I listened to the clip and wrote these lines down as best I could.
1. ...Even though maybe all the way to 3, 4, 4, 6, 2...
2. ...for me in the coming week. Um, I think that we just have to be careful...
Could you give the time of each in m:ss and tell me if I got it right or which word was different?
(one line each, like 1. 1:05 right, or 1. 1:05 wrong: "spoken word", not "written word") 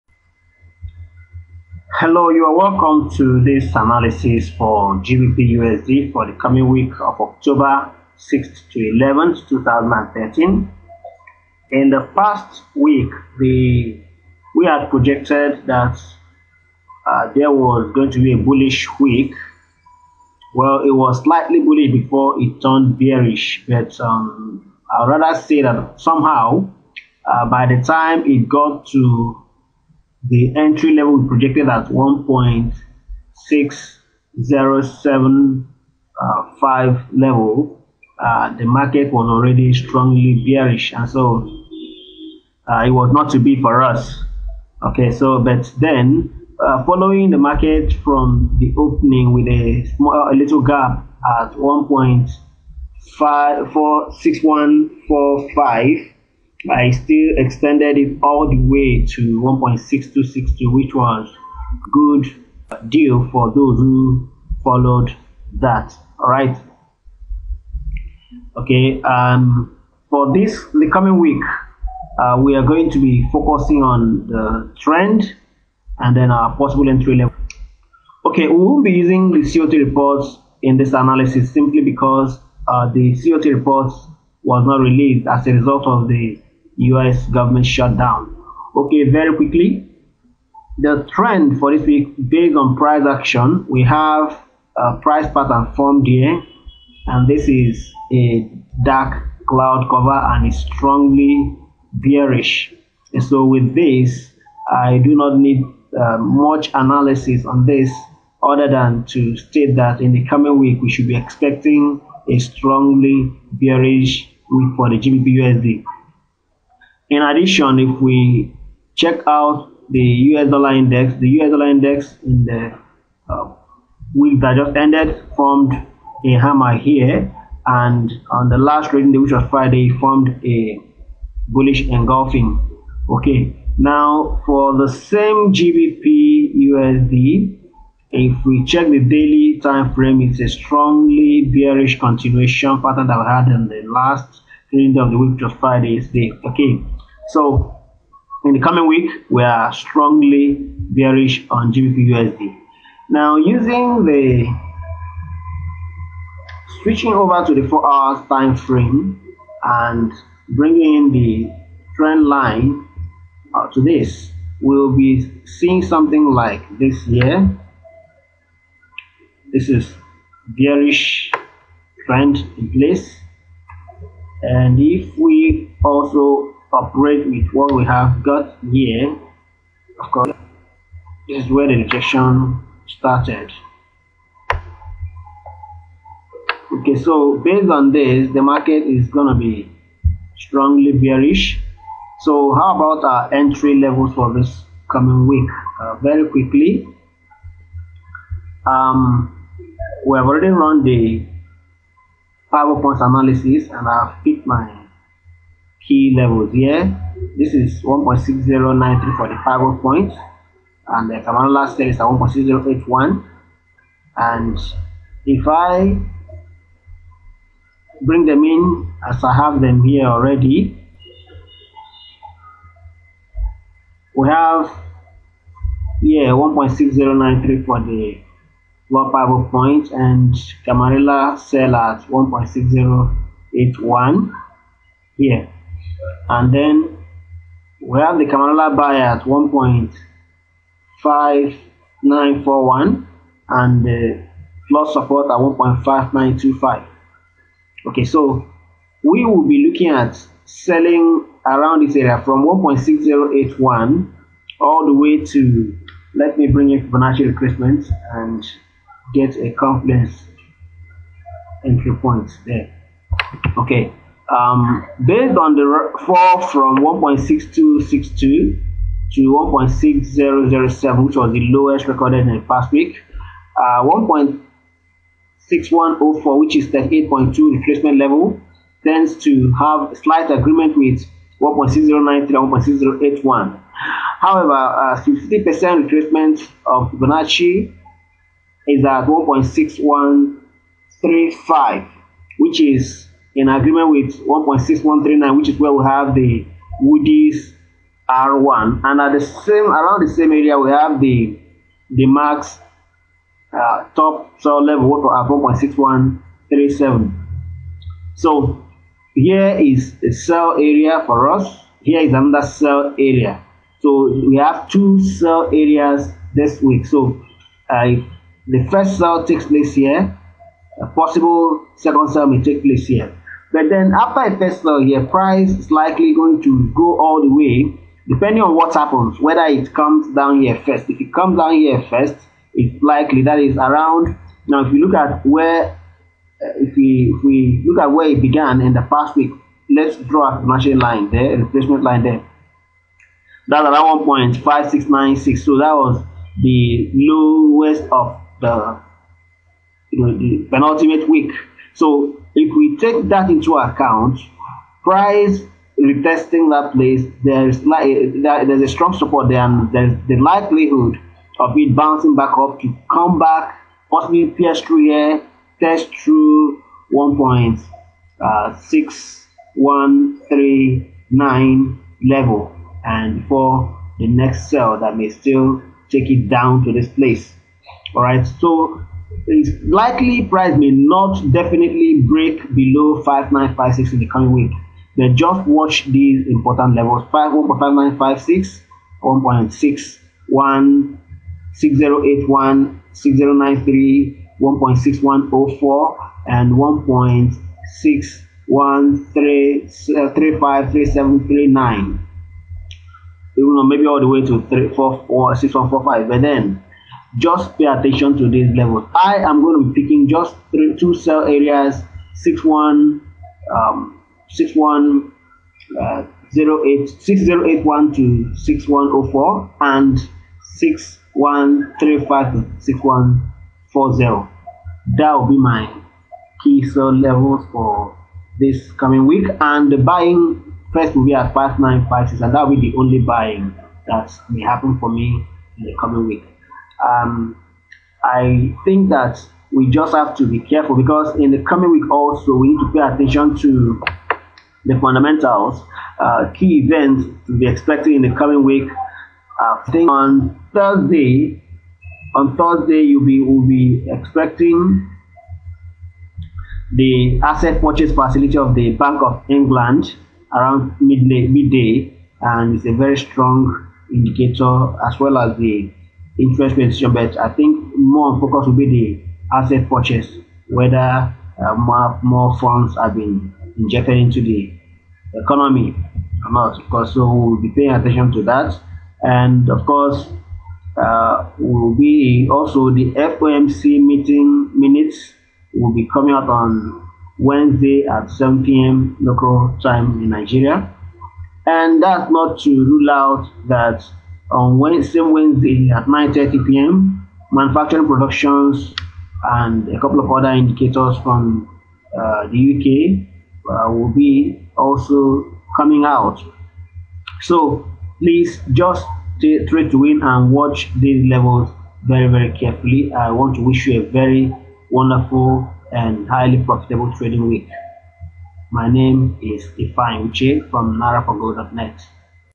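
1. 6:43 wrong: "1", not "2"
2. 7:14 right.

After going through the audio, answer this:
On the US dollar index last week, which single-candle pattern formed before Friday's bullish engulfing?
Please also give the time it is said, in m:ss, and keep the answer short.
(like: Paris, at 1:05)
hammer, at 2:06.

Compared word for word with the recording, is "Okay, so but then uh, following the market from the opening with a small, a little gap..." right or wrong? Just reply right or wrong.
right.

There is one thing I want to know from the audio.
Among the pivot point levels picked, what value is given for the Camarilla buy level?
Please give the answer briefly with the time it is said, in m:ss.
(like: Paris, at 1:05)
1.5941, at 3:59.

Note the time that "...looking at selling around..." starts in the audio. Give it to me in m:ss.
4:09.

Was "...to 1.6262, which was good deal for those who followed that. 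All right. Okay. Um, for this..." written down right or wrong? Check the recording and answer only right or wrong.
right.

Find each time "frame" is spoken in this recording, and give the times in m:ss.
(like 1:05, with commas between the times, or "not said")
2:19, 2:38.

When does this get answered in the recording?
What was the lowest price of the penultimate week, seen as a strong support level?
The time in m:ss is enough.
5:44.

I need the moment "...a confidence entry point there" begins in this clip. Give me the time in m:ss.
4:19.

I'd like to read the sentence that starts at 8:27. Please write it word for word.
So please just stay straight to win and watch these levels very, very carefully.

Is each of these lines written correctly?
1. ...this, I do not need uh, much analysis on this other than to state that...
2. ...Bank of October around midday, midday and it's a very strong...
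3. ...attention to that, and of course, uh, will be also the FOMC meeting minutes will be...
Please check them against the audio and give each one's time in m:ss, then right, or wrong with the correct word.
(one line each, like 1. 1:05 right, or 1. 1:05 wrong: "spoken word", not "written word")
1. 1:43 right
2. 7:38 wrong: "England", not "October"
3. 7:57 right.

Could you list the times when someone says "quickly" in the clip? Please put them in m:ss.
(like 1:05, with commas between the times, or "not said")
1:29, 3:16.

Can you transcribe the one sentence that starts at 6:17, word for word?
All right, so likely price may not definitely break below 5956 in the coming week.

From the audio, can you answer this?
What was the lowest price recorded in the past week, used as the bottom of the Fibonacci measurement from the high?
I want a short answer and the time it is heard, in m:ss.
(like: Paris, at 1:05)
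1.6007, at 4:29.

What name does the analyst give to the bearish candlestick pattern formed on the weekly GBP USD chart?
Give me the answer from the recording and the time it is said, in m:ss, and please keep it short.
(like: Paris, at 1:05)
dark cloud cover, at 1:38.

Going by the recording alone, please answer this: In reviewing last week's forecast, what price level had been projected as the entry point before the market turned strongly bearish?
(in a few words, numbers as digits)
1.6075.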